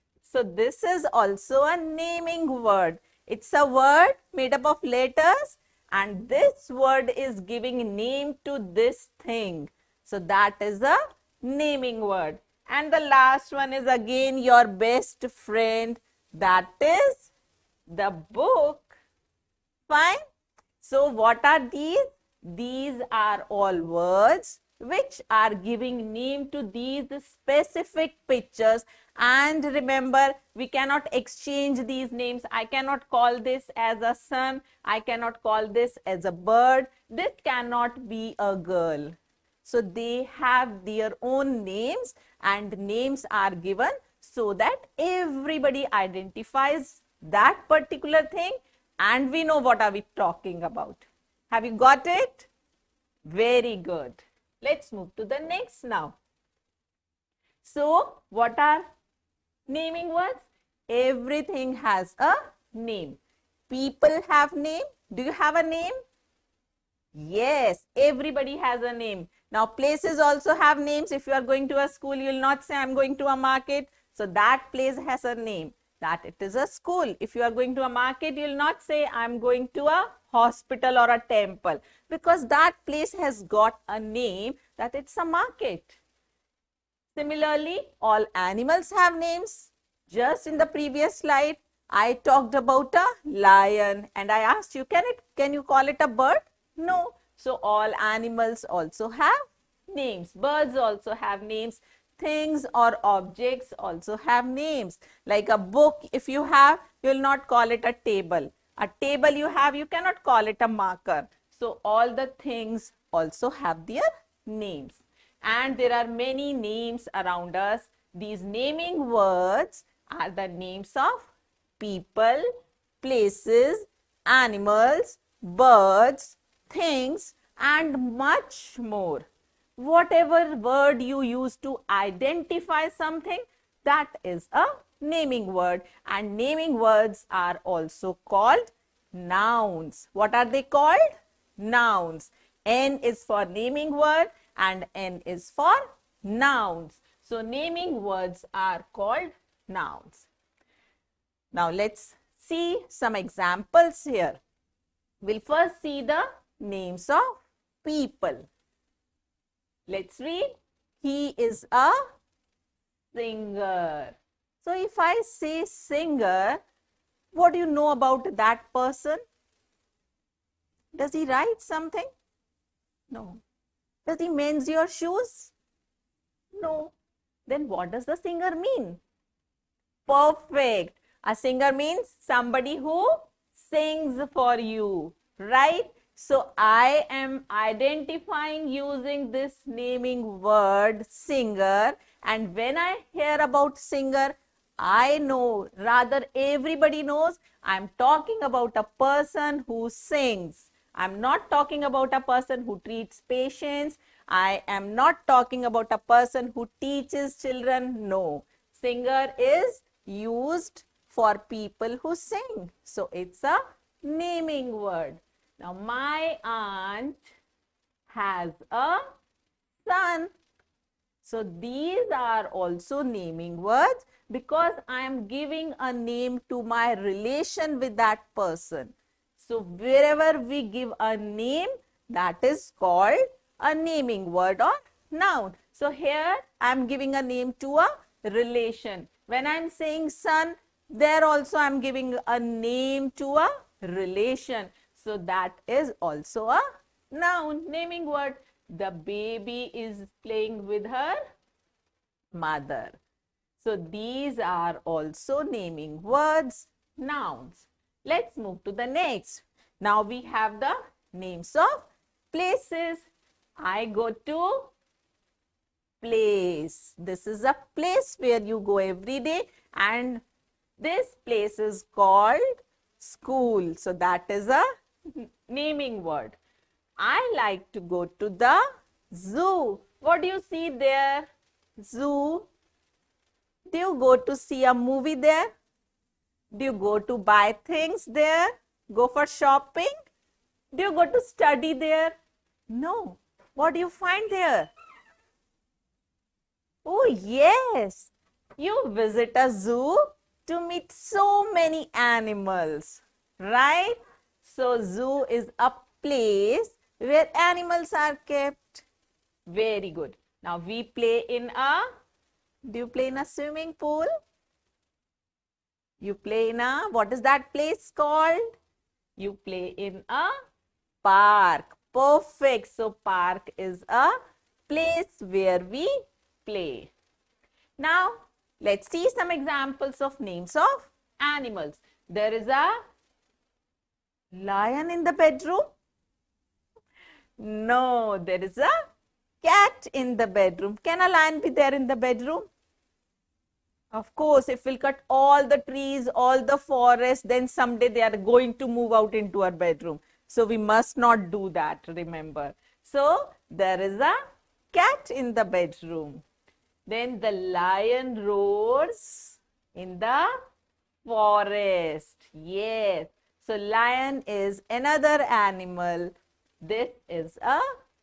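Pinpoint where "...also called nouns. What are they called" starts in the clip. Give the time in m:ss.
2:17.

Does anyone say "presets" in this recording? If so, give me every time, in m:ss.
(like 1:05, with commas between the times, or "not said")
not said.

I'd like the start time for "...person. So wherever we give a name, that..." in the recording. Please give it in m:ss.
3:48.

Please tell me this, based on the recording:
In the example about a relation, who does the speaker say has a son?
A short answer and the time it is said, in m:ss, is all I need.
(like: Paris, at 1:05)
my aunt, at 3:35.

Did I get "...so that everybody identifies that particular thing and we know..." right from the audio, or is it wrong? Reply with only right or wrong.
right.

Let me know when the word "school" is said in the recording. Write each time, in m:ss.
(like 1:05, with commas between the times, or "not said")
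1:11, 1:16, 4:32.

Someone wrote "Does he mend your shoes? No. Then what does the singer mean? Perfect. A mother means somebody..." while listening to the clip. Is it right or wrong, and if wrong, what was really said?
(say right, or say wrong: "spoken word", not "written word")
wrong: "singer", not "mother".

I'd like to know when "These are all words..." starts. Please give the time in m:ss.
0:22.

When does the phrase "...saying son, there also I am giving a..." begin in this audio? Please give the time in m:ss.
3:59.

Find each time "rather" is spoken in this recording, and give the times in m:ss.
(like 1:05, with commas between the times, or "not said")
3:15.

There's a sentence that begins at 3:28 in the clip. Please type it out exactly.
No, singer is used for people who sing.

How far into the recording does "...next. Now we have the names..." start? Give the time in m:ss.
4:18.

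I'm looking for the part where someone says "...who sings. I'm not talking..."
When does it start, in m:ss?
3:19.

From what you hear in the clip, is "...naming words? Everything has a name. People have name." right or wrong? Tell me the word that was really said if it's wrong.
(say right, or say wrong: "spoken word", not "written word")
right.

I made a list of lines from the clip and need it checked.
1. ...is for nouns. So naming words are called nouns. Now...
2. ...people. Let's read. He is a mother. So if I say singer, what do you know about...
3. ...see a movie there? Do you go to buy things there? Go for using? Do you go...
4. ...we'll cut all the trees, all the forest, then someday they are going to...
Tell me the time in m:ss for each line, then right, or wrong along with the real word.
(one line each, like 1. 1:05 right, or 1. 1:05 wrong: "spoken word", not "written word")
1. 2:25 right
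2. 2:37 wrong: "singer", not "mother"
3. 4:44 wrong: "shopping", not "using"
4. 5:44 right.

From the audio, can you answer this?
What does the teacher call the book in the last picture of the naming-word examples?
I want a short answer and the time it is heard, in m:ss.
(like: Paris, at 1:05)
your best friend, at 0:14.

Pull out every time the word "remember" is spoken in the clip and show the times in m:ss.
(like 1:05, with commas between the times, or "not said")
0:29, 5:51.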